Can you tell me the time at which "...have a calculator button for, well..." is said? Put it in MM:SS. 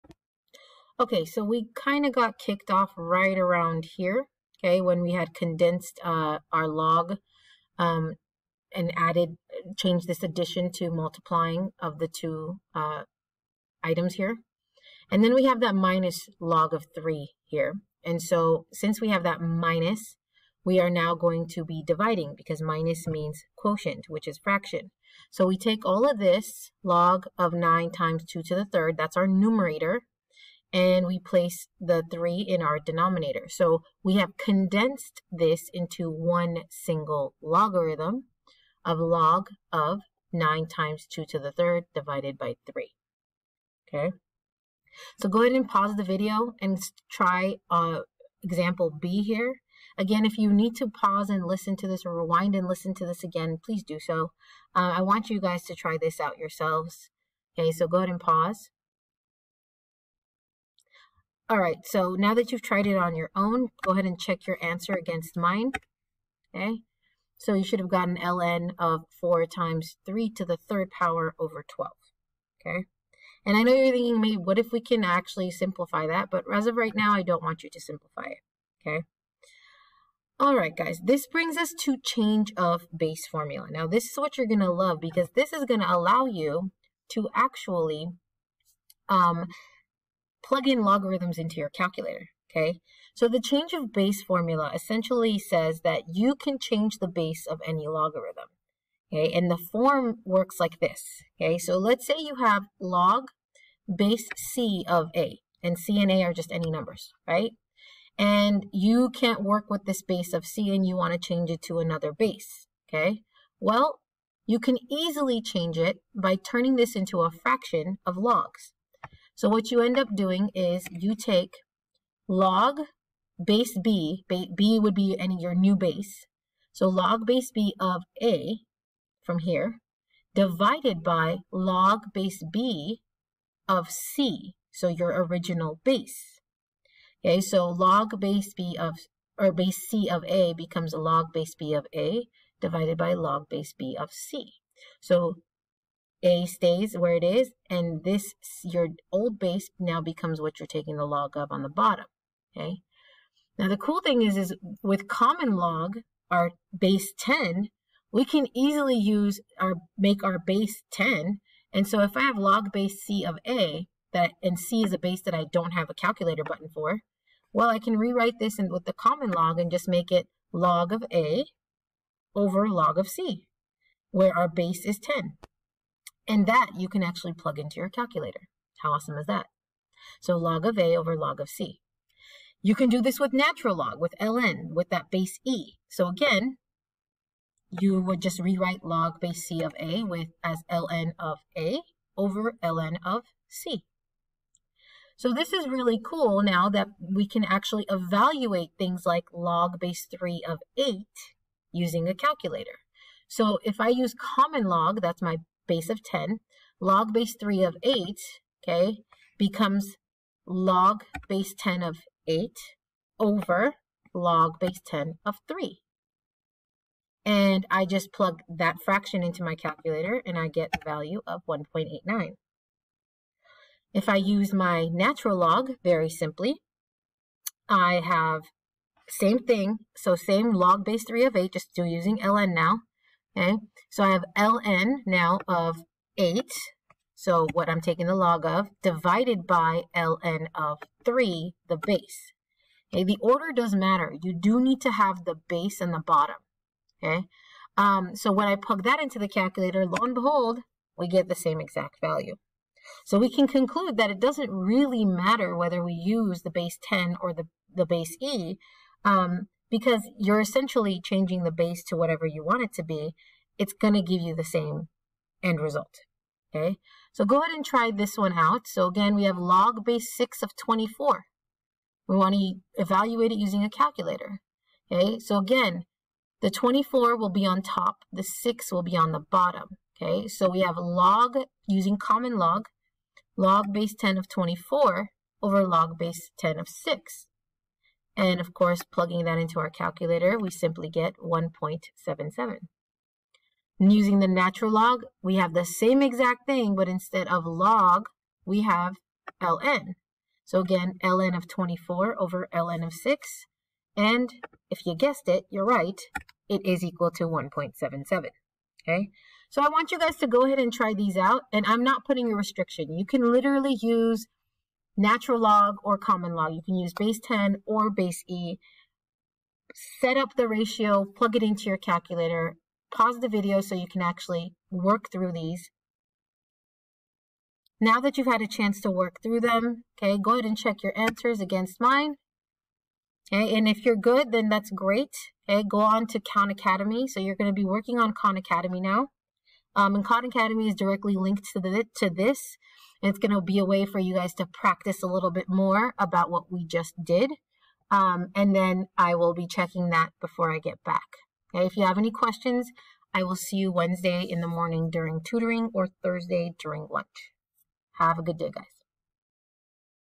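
02:45.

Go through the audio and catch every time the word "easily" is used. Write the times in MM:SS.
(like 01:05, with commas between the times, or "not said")
01:54, 02:38.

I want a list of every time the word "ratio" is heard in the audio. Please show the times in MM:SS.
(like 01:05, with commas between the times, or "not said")
05:20.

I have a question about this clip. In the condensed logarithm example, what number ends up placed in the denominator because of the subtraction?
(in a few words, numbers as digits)
3.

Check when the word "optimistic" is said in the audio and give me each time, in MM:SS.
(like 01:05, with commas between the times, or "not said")
not said.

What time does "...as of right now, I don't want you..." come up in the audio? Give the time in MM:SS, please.
01:16.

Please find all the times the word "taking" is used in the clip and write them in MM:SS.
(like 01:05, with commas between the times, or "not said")
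02:30, 03:57.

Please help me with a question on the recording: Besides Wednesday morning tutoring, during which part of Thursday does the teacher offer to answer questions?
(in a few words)
lunch.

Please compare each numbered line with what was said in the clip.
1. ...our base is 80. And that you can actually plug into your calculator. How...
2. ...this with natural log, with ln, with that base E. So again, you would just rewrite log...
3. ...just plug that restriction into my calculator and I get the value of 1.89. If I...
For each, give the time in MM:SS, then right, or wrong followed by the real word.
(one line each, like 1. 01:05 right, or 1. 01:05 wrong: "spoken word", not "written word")
1. 02:54 wrong: "10", not "80"
2. 03:03 right
3. 03:37 wrong: "fraction", not "restriction".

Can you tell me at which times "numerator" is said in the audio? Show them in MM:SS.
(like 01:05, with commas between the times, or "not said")
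00:29.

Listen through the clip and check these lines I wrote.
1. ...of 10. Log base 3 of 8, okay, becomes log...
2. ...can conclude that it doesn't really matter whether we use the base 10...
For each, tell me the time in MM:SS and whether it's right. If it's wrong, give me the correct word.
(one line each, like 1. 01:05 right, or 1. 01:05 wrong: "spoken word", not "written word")
1. 03:25 right
2. 04:13 right.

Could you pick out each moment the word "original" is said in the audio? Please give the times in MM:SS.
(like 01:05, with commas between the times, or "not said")
02:15.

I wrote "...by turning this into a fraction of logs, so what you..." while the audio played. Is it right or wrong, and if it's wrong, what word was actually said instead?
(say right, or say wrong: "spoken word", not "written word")
right.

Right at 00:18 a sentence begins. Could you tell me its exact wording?
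And so since we have that minus, we are now going to be dividing because minus means quotient, which is fraction.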